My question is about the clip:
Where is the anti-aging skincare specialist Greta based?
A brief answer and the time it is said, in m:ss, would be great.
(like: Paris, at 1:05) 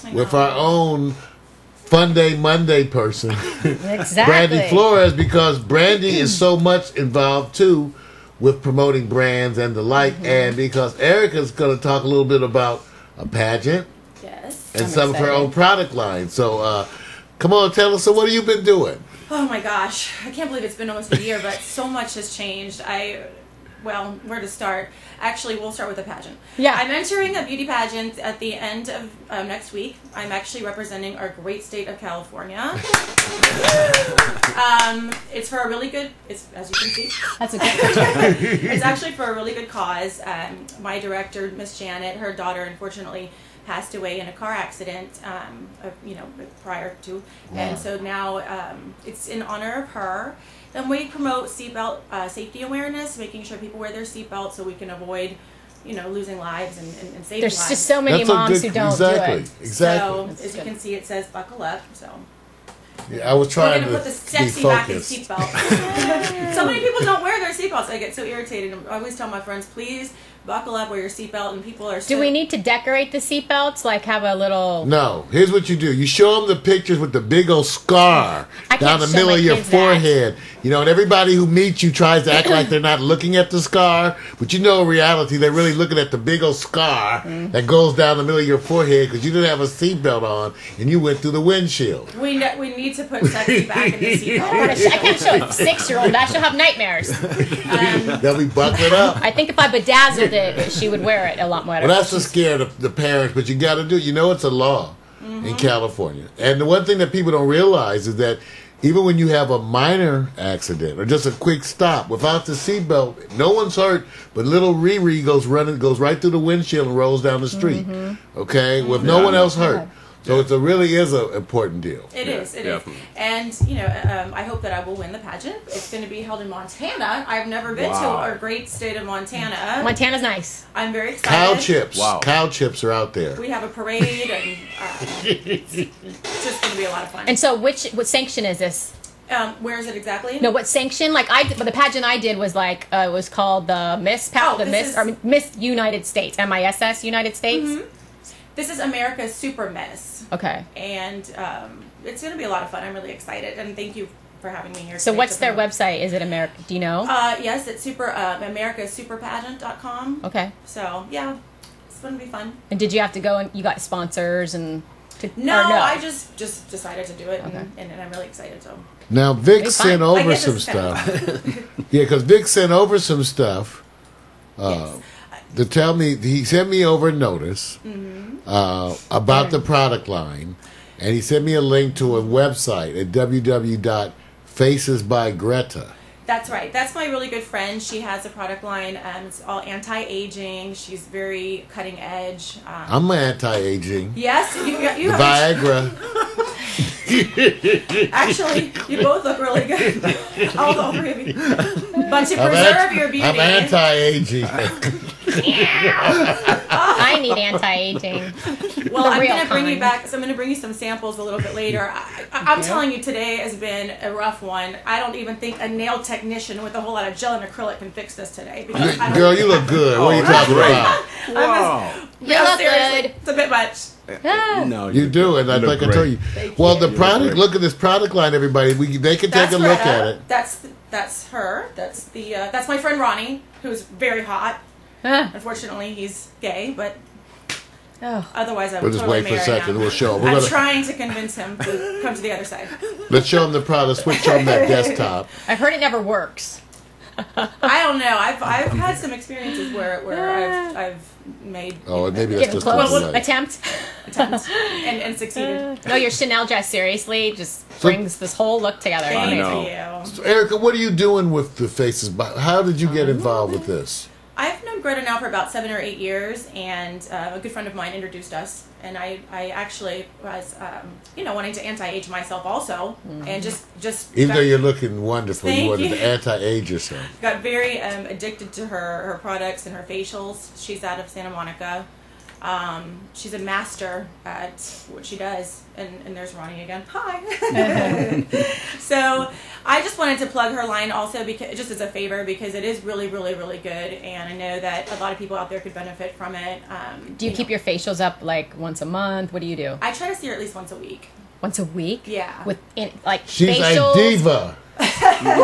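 Santa Monica, at 4:41.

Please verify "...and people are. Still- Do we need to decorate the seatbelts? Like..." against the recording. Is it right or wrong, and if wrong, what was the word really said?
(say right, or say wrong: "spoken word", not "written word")
right.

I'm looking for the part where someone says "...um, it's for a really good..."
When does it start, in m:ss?
0:34.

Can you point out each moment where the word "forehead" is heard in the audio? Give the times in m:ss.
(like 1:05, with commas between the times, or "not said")
1:19, 1:28.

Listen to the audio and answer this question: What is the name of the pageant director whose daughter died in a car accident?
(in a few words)
Miss Janet.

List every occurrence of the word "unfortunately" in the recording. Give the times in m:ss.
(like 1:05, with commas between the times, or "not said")
0:42, 3:55.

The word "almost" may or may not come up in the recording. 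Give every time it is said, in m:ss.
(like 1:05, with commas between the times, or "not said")
0:20.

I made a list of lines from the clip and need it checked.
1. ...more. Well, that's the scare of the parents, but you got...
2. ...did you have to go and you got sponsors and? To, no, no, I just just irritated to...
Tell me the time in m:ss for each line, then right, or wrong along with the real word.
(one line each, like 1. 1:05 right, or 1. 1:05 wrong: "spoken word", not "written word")
1. 1:41 right
2. 2:42 wrong: "decided", not "irritated".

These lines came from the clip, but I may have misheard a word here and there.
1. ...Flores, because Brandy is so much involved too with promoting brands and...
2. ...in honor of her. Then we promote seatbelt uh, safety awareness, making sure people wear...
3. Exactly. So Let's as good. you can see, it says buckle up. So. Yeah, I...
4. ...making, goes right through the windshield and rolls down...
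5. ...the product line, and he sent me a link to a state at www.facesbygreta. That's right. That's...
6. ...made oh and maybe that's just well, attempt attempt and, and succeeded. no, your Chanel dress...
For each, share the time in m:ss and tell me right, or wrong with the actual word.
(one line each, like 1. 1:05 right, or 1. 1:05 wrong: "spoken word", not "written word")
1. 0:04 right
2. 0:49 right
3. 0:59 wrong: "That", not "Let"
4. 1:55 wrong: "running", not "making"
5. 2:59 wrong: "website", not "state"
6. 4:11 right.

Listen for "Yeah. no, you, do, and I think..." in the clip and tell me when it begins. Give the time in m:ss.
3:44.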